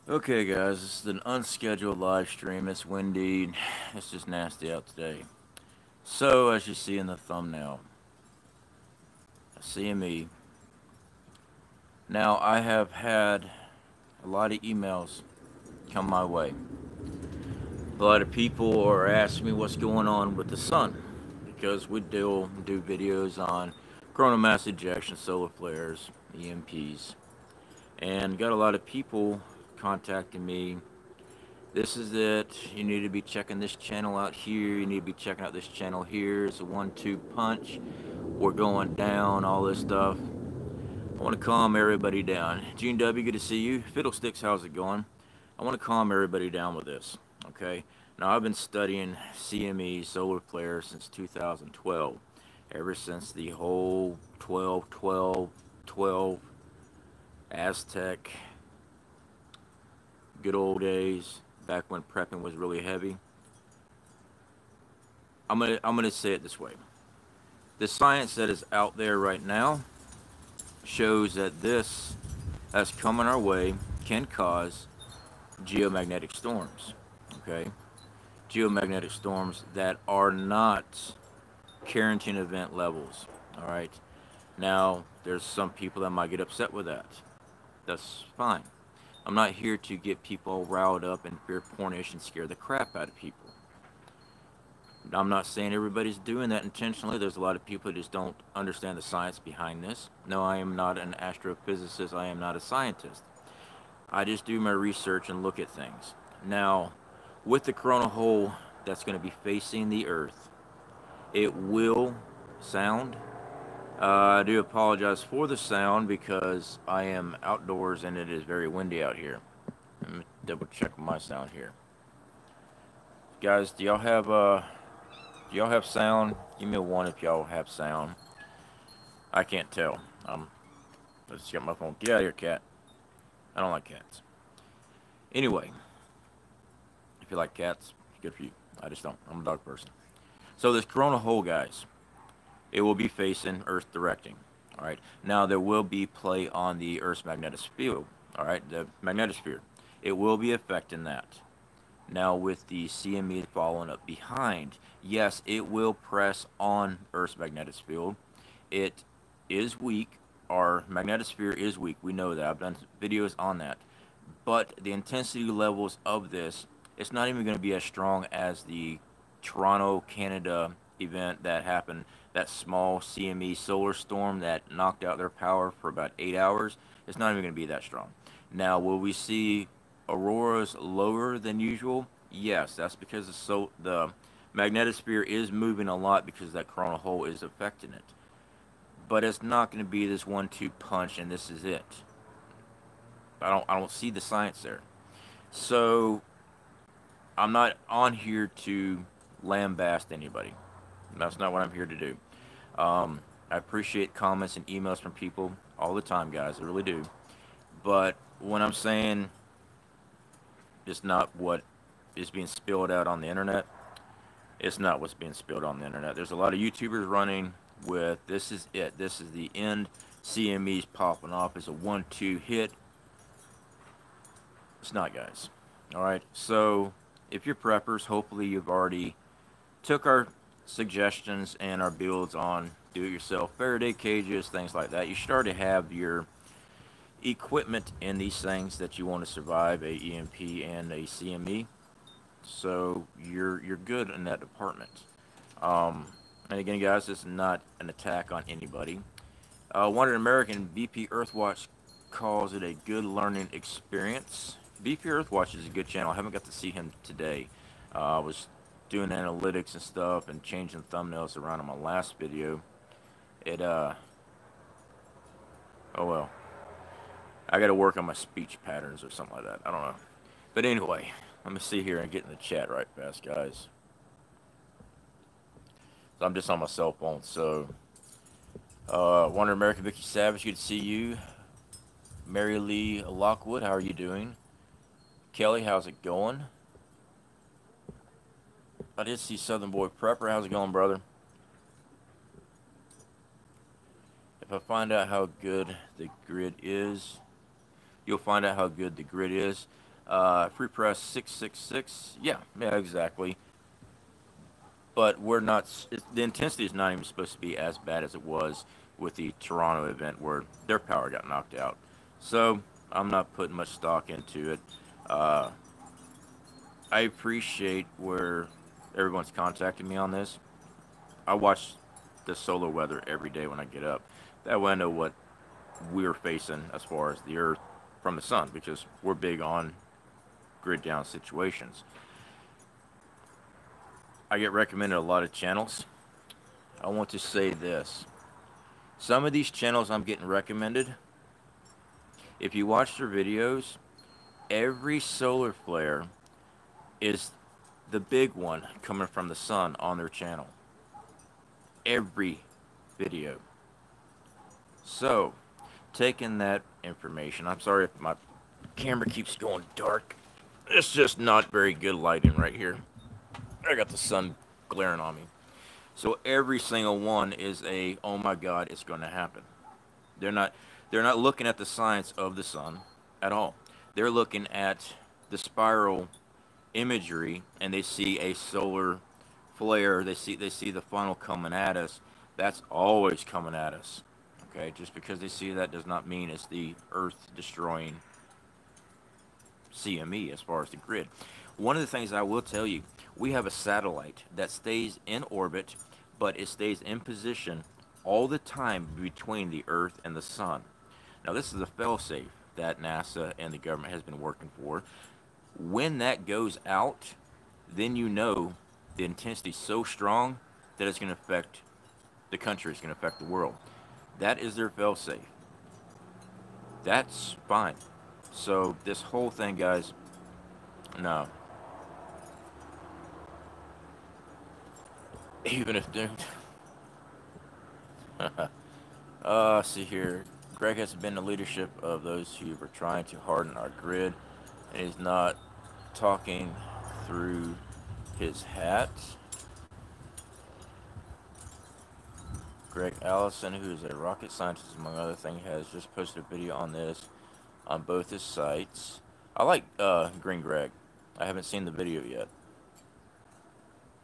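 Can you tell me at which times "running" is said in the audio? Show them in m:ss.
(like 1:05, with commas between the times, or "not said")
3:37.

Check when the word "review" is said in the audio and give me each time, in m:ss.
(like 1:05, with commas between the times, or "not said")
not said.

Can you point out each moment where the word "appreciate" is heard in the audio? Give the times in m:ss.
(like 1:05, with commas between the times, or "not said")
3:23, 5:17.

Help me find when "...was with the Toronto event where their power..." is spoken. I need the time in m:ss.
5:08.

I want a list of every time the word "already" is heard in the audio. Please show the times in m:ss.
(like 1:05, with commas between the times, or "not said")
3:48, 3:55.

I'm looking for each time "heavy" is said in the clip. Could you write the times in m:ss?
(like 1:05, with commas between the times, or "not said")
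1:02.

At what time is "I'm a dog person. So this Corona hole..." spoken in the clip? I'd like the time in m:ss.
2:19.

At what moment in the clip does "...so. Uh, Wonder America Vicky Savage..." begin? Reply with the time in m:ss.
4:37.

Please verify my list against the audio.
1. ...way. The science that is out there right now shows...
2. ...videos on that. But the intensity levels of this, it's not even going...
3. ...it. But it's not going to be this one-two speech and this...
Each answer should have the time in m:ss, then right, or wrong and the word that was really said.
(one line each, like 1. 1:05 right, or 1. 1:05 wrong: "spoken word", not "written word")
1. 1:06 right
2. 2:43 right
3. 3:07 wrong: "punch", not "speech".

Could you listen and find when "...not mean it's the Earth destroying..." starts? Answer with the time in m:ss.
6:25.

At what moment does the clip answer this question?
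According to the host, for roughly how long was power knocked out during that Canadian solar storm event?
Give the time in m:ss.
2:55.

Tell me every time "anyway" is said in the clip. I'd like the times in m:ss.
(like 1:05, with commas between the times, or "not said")
2:15, 4:30.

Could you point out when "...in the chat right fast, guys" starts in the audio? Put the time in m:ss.
4:32.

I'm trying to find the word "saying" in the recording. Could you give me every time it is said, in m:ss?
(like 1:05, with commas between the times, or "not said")
1:35, 3:28.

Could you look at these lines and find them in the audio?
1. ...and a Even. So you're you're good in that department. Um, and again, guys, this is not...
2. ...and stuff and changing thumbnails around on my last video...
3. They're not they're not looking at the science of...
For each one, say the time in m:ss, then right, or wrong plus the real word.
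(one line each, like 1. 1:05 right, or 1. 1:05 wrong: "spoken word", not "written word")
1. 4:00 wrong: "CME", not "Even"
2. 4:19 right
3. 6:10 right.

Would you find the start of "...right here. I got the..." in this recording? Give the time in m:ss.
6:02.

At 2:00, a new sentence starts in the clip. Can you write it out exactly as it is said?
Let me double check my sound here.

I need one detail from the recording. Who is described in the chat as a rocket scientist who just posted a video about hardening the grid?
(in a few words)
Greg Allison.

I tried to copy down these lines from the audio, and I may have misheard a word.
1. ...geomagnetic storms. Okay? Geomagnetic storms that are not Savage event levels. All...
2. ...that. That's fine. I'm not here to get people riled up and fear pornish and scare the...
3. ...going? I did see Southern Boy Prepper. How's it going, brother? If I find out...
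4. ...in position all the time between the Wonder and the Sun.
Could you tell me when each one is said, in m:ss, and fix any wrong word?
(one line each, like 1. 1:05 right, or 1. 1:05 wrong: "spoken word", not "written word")
1. 1:15 wrong: "Carrington", not "Savage"
2. 1:26 right
3. 4:46 right
4. 6:36 wrong: "Earth", not "Wonder".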